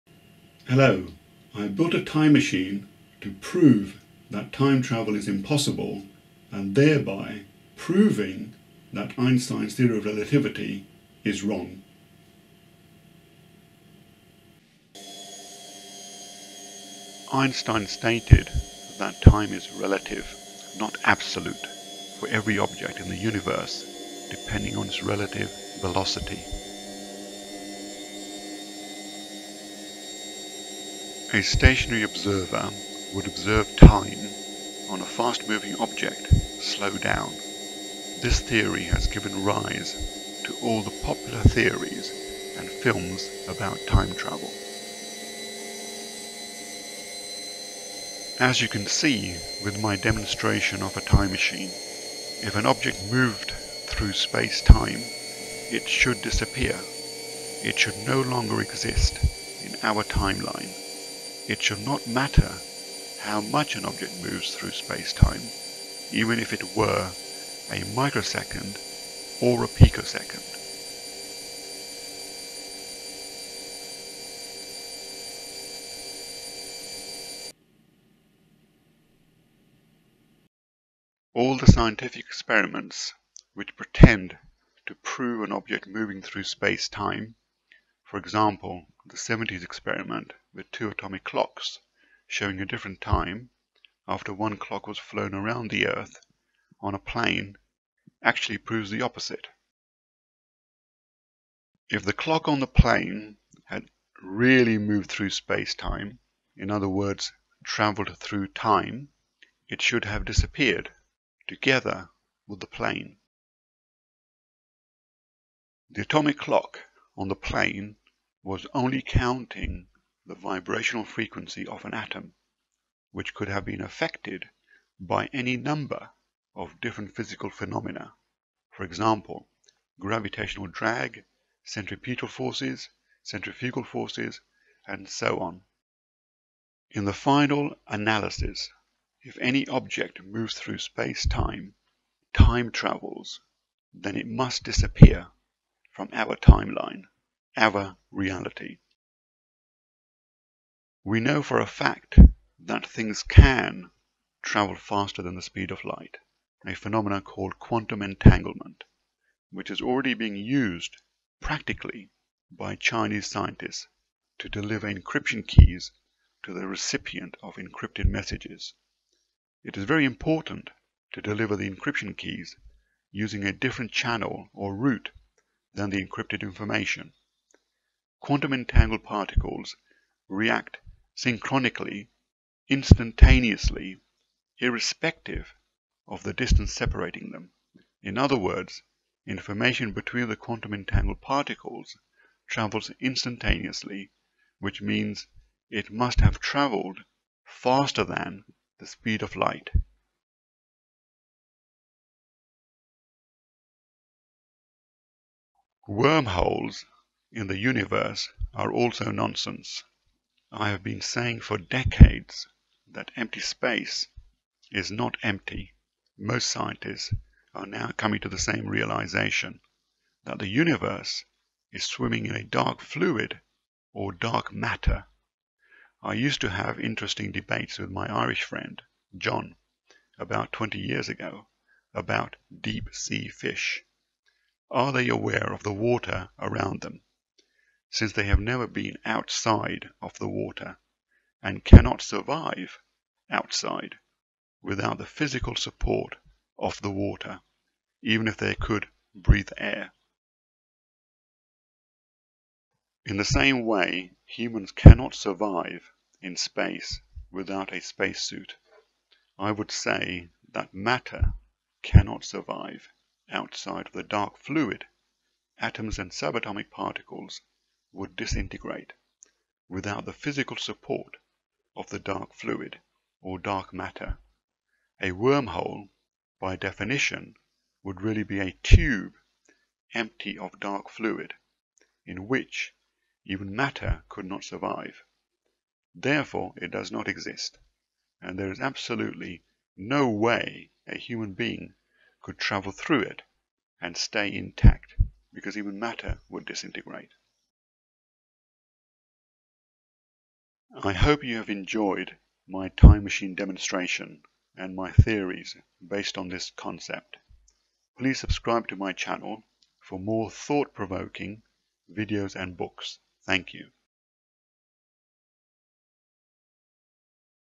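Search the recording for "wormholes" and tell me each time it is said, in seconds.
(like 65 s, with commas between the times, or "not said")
205 s, 275 s.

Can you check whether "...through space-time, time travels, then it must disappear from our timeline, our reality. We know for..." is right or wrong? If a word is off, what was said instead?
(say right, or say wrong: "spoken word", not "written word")
right.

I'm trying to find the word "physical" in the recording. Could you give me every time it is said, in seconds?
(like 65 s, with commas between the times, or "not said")
127 s, 245 s, 270 s.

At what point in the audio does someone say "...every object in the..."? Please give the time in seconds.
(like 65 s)
22 s.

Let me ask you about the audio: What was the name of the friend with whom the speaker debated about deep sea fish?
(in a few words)
John.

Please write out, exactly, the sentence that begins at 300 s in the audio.
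I hope you have enjoyed my time machine demonstration and my theories based on this concept.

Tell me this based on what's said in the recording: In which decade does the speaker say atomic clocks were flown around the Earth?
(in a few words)
the 70s.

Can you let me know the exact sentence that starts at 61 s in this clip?
It should not matter how much an object moves through space-time, even if it were a microsecond or a picosecond.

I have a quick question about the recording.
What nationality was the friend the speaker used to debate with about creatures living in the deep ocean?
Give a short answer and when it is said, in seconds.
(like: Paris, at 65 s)
Irish, at 228 s.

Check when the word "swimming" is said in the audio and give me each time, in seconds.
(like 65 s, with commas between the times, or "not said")
221 s.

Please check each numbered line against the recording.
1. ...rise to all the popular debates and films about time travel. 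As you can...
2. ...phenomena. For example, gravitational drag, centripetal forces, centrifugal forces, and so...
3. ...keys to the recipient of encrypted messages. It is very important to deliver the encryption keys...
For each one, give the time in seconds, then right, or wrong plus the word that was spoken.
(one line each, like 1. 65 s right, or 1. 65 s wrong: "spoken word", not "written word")
1. 39 s wrong: "theories", not "debates"
2. 127 s right
3. 165 s right.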